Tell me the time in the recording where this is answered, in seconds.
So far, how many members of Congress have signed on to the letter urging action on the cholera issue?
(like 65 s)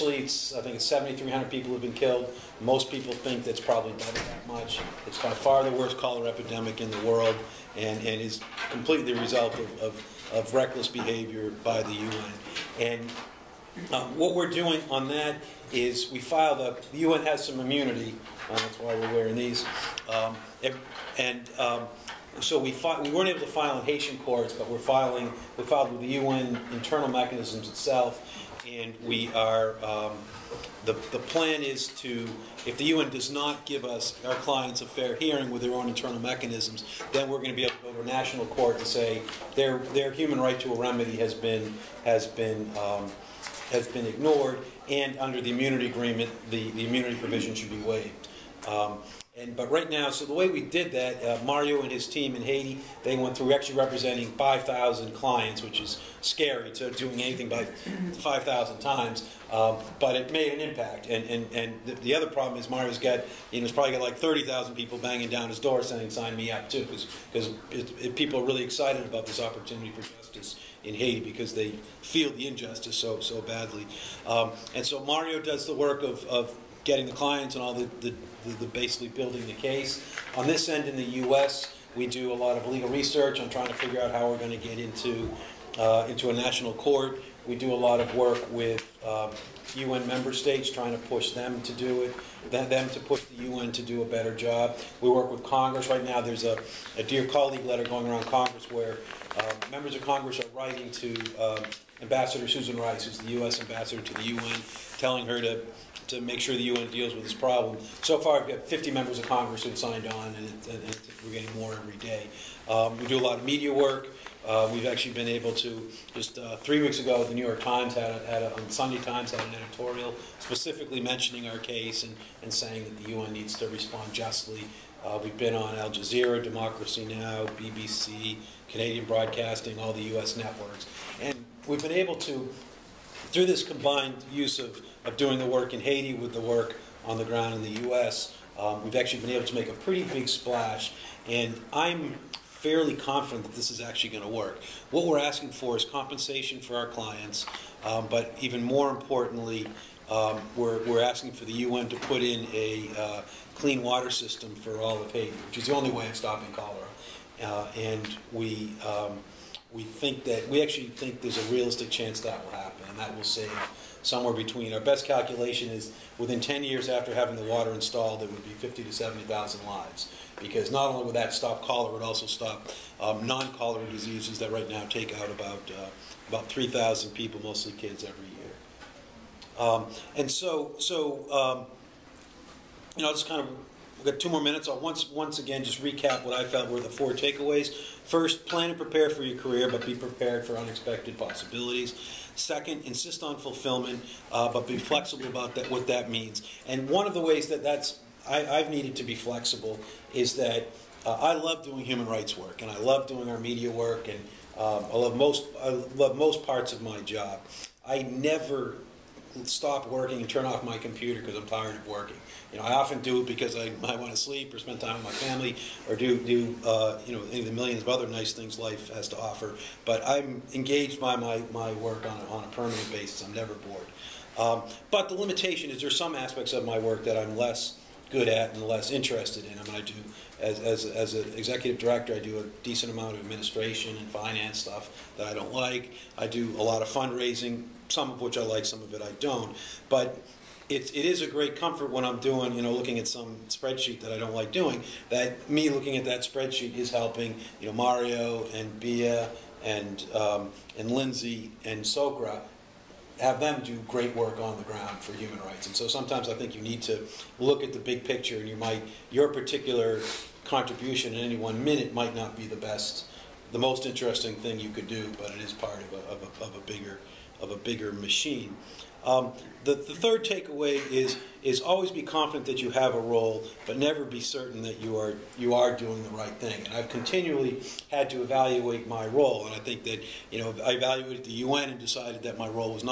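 108 s.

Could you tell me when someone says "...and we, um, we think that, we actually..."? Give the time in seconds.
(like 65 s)
157 s.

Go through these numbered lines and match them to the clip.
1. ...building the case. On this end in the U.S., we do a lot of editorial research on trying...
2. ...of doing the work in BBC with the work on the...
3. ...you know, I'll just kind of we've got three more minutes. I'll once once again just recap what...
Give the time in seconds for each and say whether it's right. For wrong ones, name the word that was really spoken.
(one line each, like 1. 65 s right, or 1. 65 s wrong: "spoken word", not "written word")
1. 79 s wrong: "legal", not "editorial"
2. 135 s wrong: "Haiti", not "BBC"
3. 182 s wrong: "two", not "three".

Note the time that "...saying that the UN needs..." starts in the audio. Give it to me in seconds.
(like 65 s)
122 s.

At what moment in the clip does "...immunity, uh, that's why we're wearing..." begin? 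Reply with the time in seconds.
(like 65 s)
17 s.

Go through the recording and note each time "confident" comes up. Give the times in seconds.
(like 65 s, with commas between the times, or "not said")
142 s, 272 s.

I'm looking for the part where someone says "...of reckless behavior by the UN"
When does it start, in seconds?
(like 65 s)
10 s.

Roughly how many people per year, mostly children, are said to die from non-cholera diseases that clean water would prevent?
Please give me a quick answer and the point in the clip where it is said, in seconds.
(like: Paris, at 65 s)
3,000, at 176 s.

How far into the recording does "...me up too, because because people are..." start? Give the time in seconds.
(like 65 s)
66 s.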